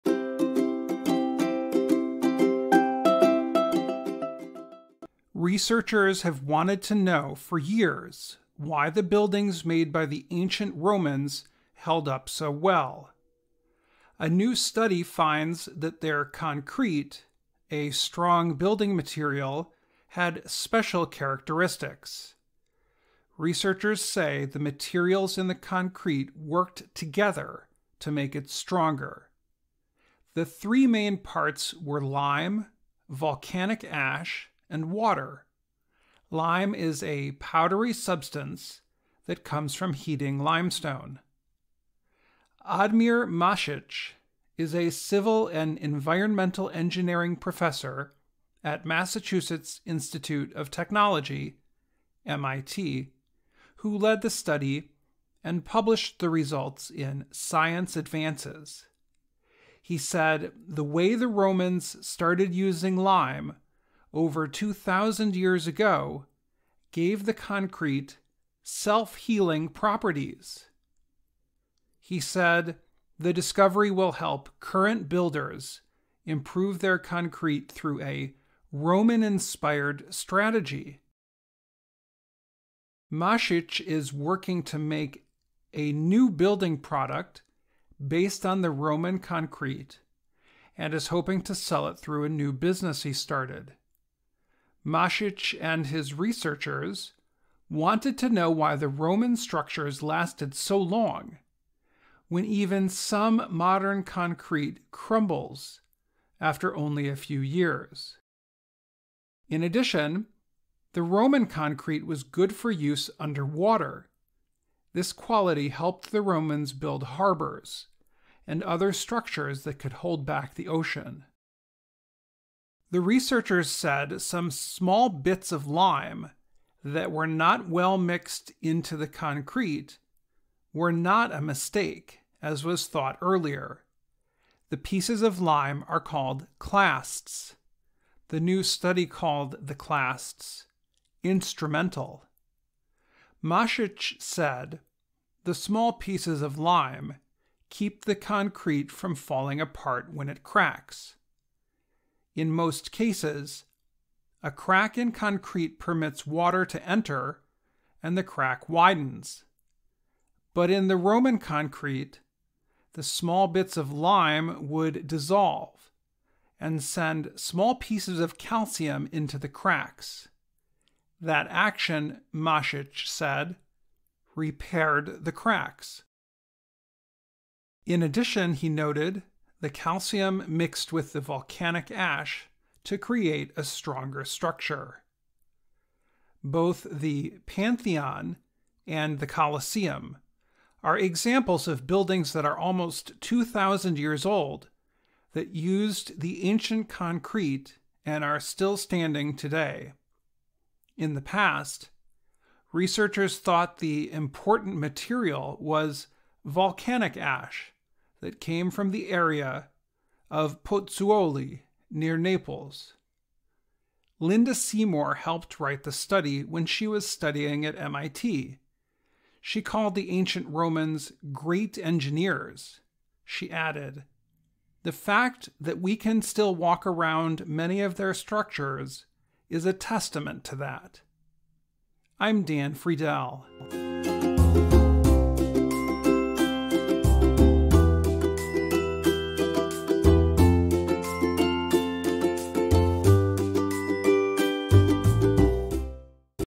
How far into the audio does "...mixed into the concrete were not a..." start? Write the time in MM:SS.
02:07.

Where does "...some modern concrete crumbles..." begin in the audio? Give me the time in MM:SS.
01:42.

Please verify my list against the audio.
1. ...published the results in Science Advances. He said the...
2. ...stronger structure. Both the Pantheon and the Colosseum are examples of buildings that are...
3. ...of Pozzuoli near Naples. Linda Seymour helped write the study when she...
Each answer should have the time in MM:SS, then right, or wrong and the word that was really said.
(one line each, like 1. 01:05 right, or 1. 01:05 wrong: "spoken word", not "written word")
1. 00:55 right
2. 03:03 right
3. 03:30 right.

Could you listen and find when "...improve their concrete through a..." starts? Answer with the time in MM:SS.
01:16.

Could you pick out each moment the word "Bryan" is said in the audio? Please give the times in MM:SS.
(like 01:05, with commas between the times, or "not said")
not said.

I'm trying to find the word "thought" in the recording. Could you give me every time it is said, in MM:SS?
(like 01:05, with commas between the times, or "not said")
02:12, 03:23.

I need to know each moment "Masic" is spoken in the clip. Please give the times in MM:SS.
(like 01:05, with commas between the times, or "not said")
00:43, 01:23, 01:34, 02:23, 02:52.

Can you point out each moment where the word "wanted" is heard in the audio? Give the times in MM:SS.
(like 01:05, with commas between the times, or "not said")
00:06, 01:37.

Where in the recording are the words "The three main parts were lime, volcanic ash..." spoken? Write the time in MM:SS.
00:30.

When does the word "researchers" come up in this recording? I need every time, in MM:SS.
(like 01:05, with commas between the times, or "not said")
00:05, 00:23, 01:36, 02:03, 03:22.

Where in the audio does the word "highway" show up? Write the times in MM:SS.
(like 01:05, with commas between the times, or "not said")
not said.